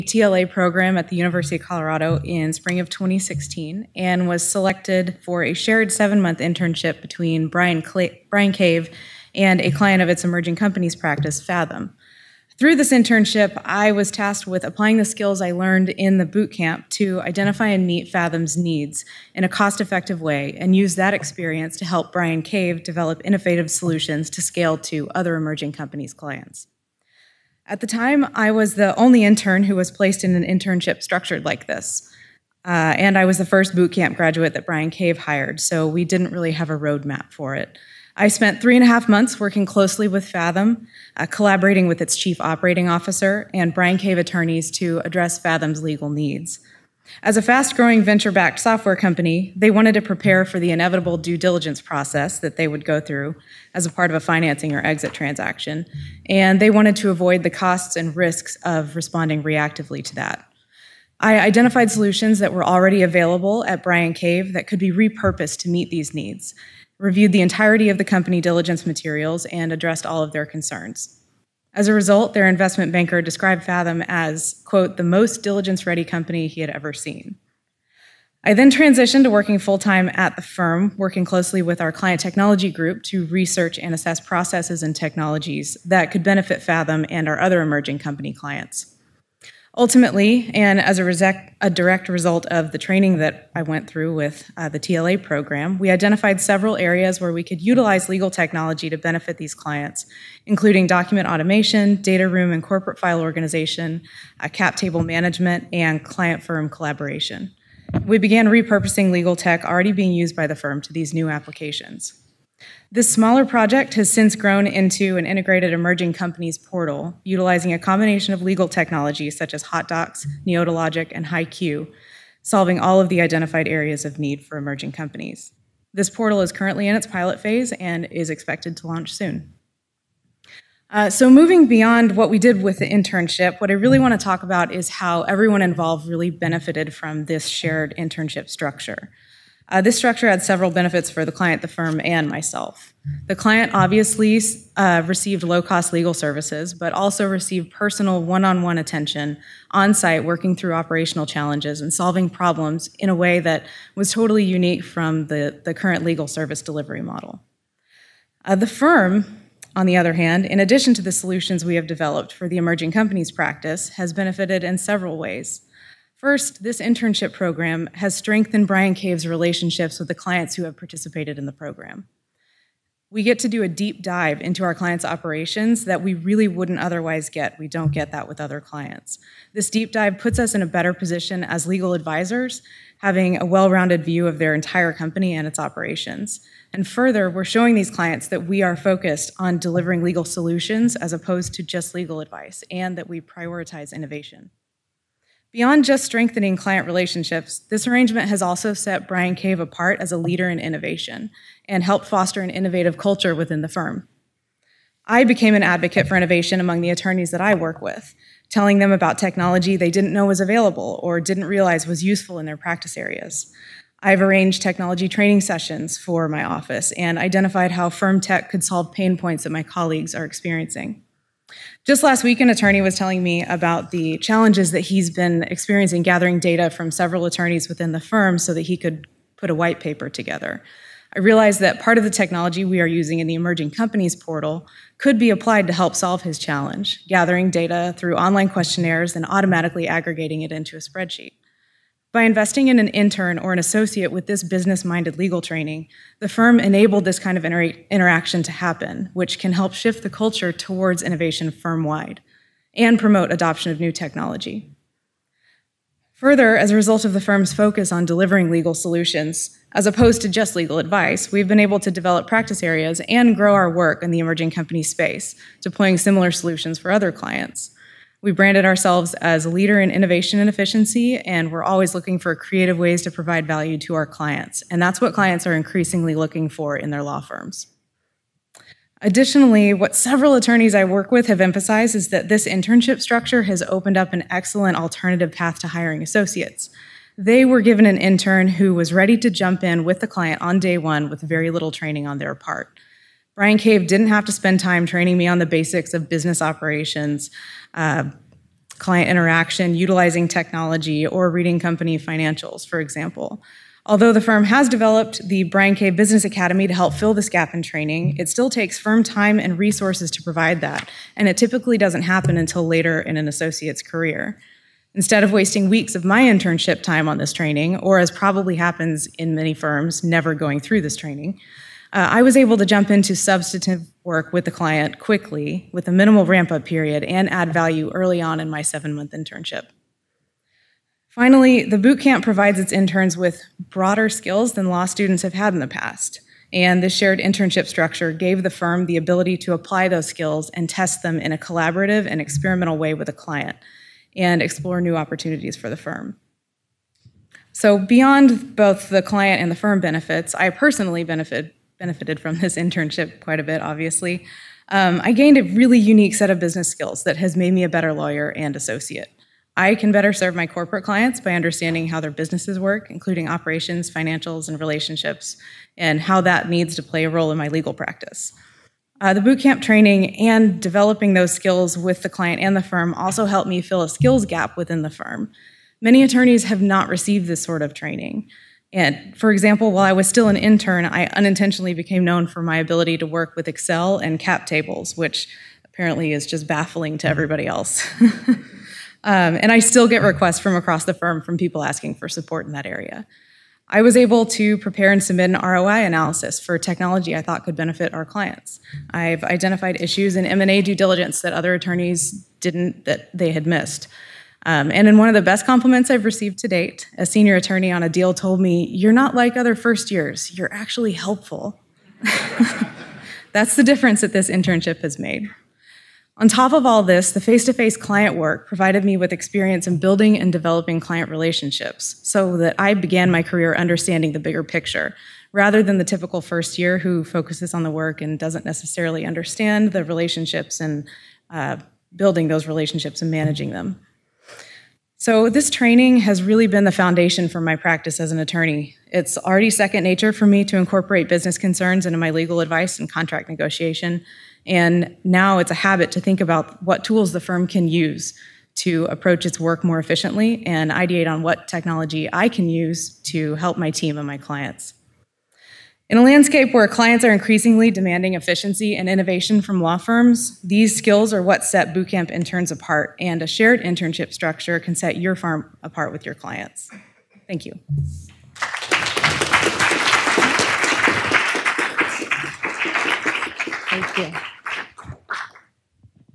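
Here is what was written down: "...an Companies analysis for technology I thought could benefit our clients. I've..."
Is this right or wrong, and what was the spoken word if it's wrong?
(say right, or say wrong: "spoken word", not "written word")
wrong: "ROI", not "Companies".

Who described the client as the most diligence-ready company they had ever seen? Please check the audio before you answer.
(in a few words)
their investment banker.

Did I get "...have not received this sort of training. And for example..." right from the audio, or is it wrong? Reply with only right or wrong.
right.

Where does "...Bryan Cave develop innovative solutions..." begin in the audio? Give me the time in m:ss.
0:22.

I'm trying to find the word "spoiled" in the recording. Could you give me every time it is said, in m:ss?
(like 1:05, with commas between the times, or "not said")
not said.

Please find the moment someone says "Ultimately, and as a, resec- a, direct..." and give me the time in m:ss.
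1:29.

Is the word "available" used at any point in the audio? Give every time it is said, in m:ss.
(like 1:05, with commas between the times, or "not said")
1:03, 3:30.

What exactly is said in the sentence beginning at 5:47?
So, beyond both the client and the firm benefits, I personally benefit benefited from this internship quite a bit, obviously.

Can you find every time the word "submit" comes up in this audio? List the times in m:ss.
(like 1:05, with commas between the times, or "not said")
6:35.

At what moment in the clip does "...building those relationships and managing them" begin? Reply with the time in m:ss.
7:11.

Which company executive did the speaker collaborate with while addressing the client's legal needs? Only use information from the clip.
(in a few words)
chief operating officer.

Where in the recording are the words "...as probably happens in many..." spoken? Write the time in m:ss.
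5:17.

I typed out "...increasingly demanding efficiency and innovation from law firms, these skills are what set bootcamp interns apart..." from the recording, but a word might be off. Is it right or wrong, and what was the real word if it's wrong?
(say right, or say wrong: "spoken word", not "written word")
right.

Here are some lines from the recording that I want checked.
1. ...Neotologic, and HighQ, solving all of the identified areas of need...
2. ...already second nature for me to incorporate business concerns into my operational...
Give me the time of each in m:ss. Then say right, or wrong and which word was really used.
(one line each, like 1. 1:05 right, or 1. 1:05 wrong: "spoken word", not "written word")
1. 2:00 right
2. 7:19 wrong: "legal", not "operational".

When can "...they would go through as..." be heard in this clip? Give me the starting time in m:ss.
0:52.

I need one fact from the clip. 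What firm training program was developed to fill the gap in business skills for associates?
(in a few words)
Bryan Cave Business Academy.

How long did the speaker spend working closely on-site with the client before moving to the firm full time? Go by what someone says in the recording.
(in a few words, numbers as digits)
three and a half months.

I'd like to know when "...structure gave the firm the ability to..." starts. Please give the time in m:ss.
5:37.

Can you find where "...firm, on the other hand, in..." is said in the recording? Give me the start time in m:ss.
2:38.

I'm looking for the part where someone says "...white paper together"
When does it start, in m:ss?
3:49.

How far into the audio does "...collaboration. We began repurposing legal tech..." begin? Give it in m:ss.
1:46.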